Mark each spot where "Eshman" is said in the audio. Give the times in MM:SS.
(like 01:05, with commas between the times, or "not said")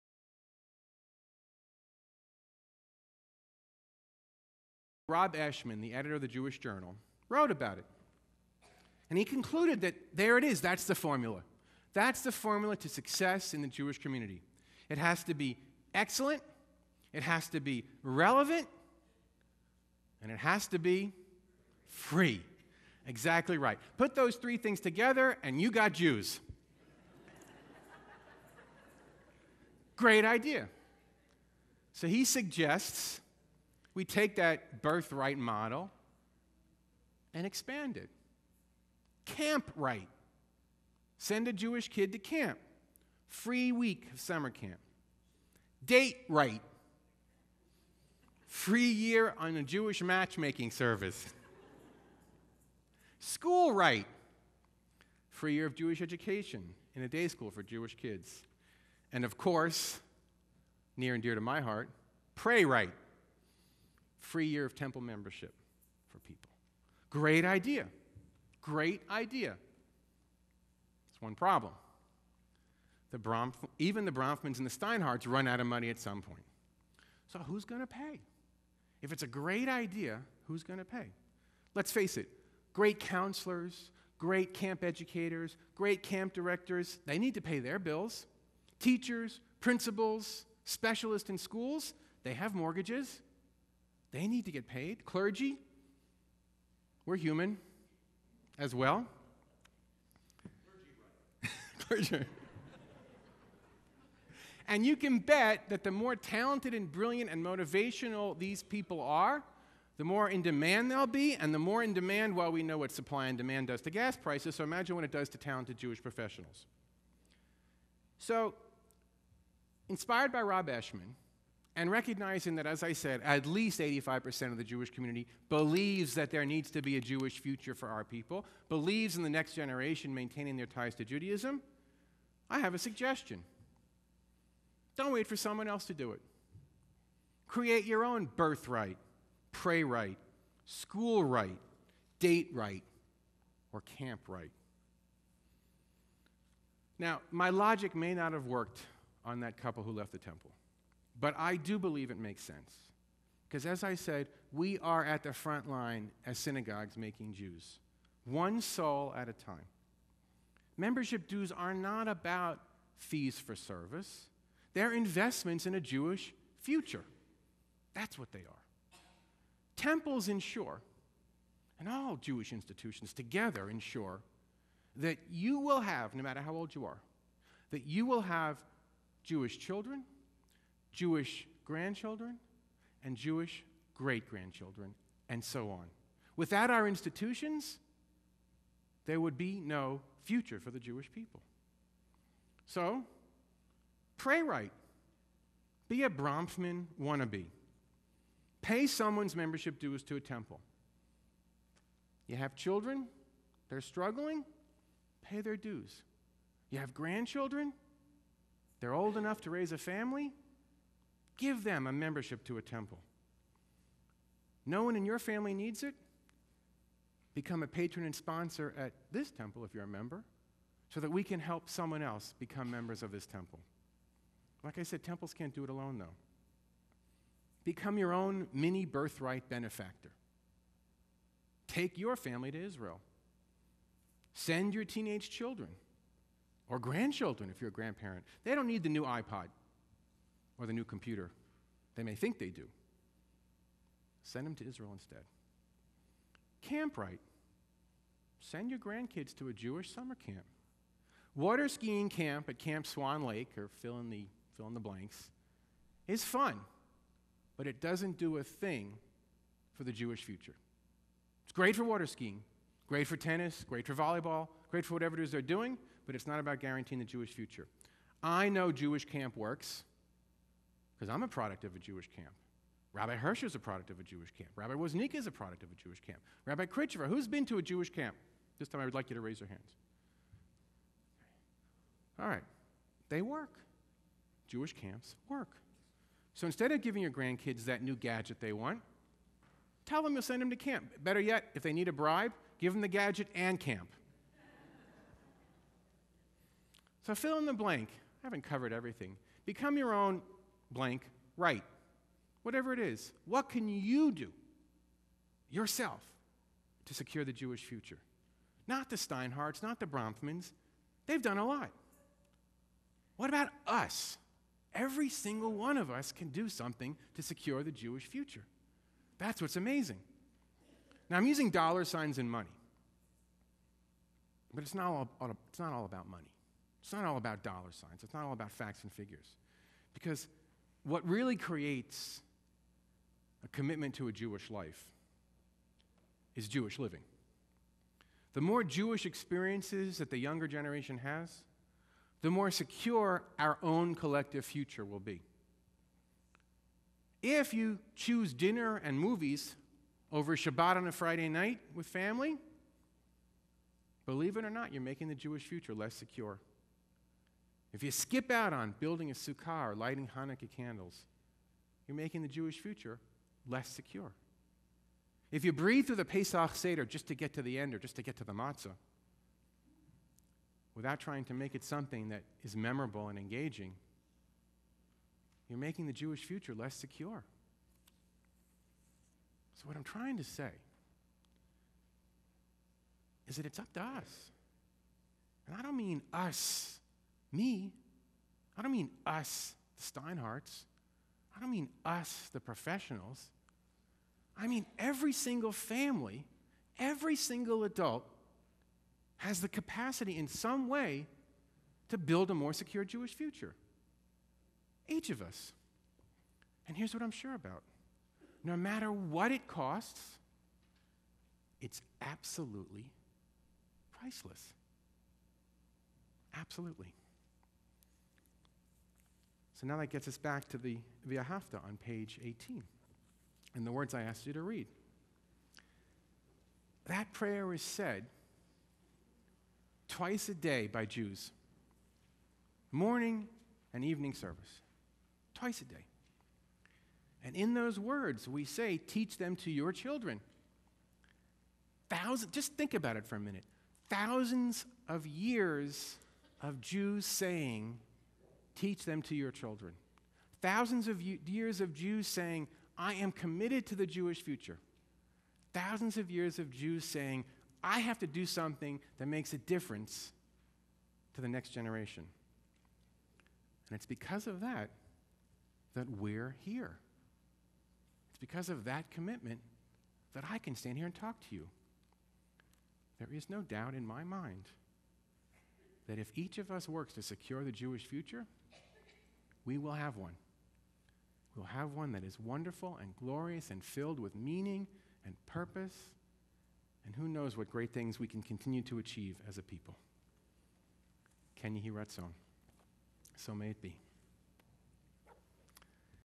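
00:05, 02:00.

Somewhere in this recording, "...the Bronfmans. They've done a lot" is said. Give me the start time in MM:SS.
05:09.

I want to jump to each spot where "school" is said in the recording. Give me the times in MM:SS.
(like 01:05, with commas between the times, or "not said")
00:53, 00:57, 01:31, 02:20.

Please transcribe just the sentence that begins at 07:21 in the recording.
Thousands, just think about it for a minute.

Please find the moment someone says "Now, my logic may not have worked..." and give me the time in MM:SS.
02:26.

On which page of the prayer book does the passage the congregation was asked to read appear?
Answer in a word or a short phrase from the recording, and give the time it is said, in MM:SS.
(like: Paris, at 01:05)
18, at 07:02.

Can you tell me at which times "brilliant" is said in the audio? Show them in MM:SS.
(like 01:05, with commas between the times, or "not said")
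01:46.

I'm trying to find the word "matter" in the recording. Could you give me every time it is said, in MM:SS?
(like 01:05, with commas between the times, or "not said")
02:56, 06:48.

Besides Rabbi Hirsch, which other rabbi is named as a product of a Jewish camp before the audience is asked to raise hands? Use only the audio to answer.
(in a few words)
Rabbi Woznica.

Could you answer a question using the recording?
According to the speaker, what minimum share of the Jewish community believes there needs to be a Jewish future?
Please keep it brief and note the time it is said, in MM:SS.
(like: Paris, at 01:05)
85%, at 02:03.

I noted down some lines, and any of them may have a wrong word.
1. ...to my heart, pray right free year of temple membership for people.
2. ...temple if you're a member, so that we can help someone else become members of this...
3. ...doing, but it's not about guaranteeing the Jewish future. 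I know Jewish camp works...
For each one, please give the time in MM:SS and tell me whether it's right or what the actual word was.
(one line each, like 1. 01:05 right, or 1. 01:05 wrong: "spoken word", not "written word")
1. 01:01 right
2. 03:39 right
3. 04:25 right.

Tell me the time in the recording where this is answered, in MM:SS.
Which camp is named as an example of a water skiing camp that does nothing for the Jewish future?
04:12.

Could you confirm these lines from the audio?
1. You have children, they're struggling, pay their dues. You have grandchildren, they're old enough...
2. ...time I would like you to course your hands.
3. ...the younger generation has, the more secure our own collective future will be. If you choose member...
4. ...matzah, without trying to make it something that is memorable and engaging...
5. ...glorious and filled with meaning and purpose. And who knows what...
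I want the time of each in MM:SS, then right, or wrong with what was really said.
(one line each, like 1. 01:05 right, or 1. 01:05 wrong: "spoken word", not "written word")
1. 03:22 right
2. 04:38 wrong: "raise", not "course"
3. 05:40 wrong: "dinner", not "member"
4. 06:08 right
5. 08:02 right.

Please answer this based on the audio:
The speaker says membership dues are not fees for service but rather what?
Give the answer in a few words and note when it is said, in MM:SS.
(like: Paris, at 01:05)
investments in a Jewish future, at 02:44.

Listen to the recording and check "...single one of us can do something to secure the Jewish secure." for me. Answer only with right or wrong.
wrong.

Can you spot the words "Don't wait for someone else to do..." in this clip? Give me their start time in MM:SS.
02:14.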